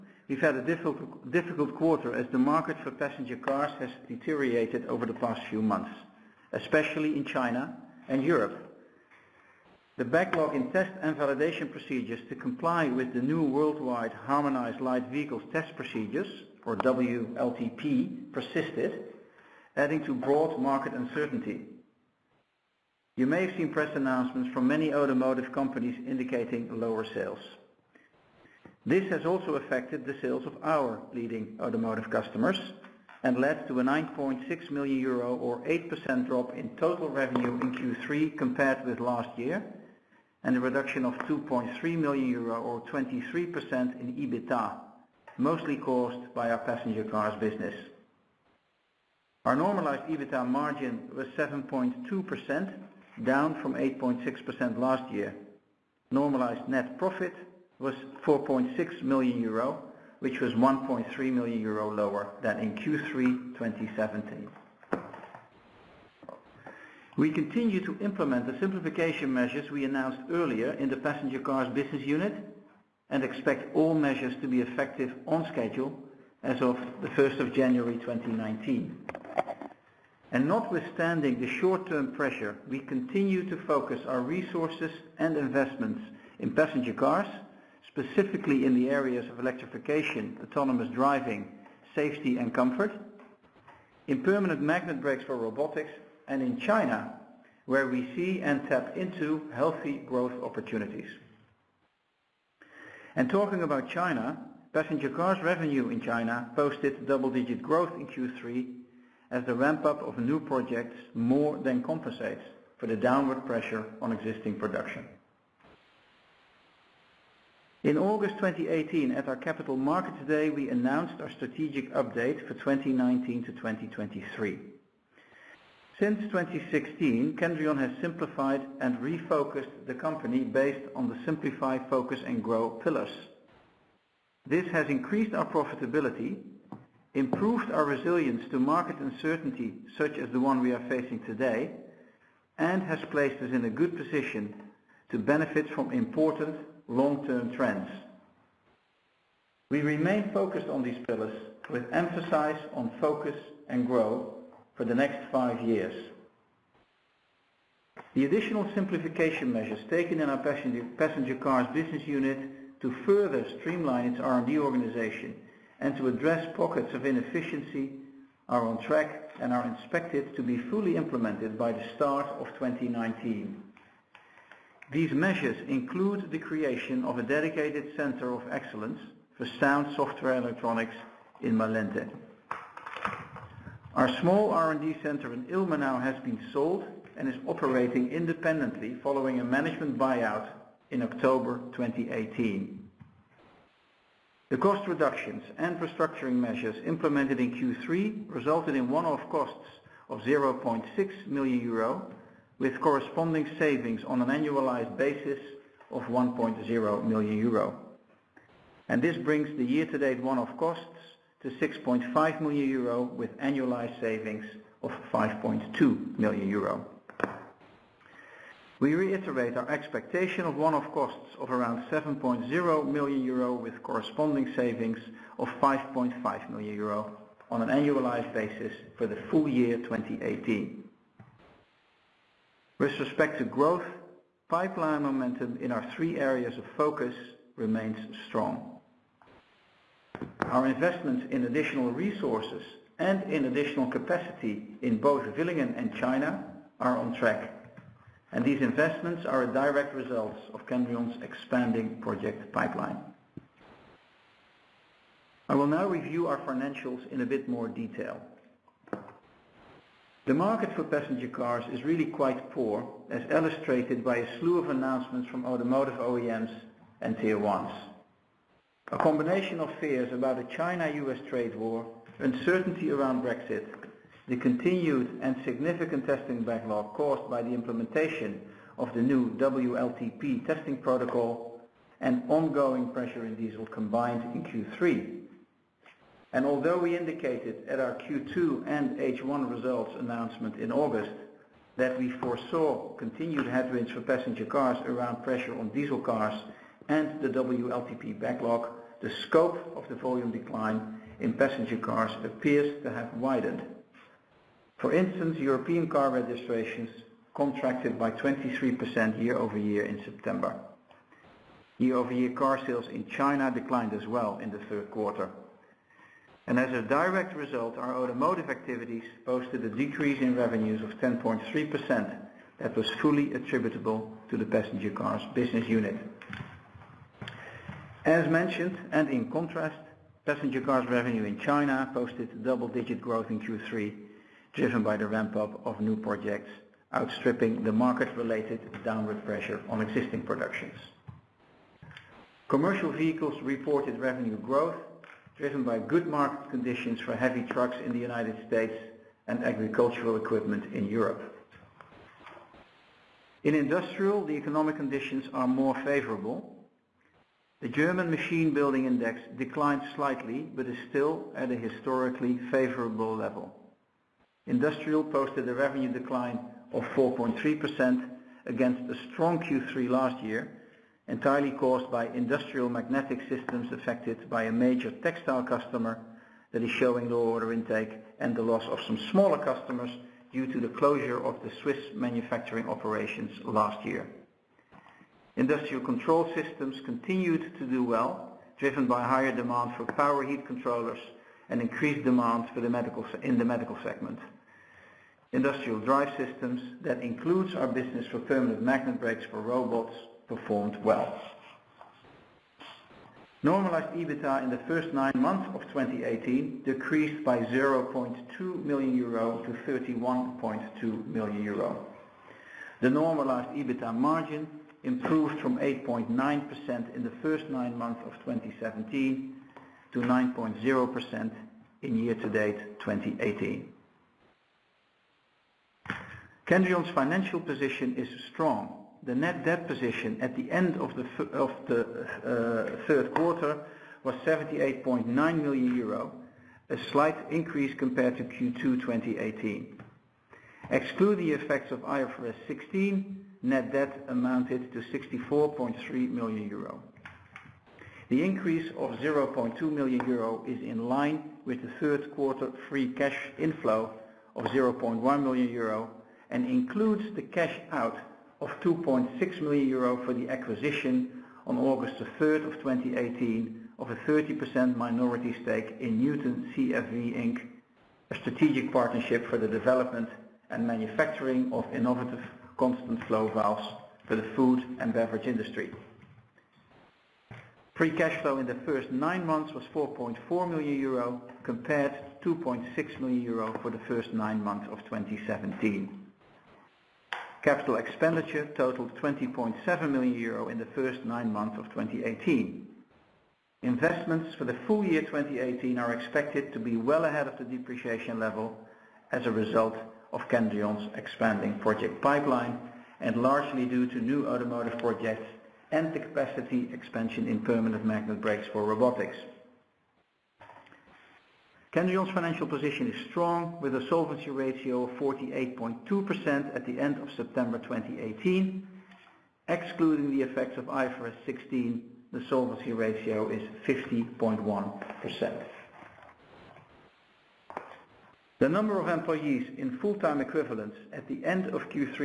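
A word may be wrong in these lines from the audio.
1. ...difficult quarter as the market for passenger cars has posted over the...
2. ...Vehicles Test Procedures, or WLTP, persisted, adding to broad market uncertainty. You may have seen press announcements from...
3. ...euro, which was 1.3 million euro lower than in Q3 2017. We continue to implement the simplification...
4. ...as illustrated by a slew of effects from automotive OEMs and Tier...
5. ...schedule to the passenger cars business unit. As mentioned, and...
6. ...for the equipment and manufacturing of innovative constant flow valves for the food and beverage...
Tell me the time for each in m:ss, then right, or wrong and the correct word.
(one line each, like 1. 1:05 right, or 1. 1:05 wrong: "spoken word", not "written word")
1. 0:01 wrong: "deteriorated", not "posted"
2. 0:15 right
3. 0:59 right
4. 4:23 wrong: "announcements", not "effects"
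5. 5:23 wrong: "attributable", not "schedule"
6. 7:49 wrong: "development", not "equipment".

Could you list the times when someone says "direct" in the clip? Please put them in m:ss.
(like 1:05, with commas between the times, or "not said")
4:09, 5:16.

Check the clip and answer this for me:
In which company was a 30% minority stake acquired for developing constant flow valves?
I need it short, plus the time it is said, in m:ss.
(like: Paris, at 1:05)
Newton CFV Inc., at 7:46.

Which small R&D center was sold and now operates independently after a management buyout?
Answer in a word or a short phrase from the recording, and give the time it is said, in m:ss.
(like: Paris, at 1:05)
Ilmenau, at 3:05.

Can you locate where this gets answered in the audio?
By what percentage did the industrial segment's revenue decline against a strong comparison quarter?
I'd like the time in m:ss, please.
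6:06.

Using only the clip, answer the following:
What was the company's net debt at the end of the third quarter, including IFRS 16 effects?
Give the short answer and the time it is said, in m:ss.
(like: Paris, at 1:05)
78.9 million euro, at 7:14.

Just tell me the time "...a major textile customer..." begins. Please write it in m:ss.
6:14.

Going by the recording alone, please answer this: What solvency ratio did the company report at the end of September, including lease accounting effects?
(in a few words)
48.2%.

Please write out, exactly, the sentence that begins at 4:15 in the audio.
I will now review our financials in a bit more detail.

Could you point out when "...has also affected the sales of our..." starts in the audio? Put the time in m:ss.
0:29.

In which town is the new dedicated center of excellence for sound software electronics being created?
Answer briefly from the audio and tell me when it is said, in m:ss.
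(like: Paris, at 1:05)
Malente, at 3:01.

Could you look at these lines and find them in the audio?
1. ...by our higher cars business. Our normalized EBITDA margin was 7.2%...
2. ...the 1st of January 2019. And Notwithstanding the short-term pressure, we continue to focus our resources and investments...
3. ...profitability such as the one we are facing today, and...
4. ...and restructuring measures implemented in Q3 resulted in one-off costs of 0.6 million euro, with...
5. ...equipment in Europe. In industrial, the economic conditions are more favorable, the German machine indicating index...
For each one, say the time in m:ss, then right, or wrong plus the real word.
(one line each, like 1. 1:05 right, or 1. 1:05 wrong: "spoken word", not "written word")
1. 0:46 wrong: "passenger", not "higher"
2. 1:17 right
3. 2:18 wrong: "uncertainty", not "profitability"
4. 3:15 right
5. 5:50 wrong: "building", not "indicating".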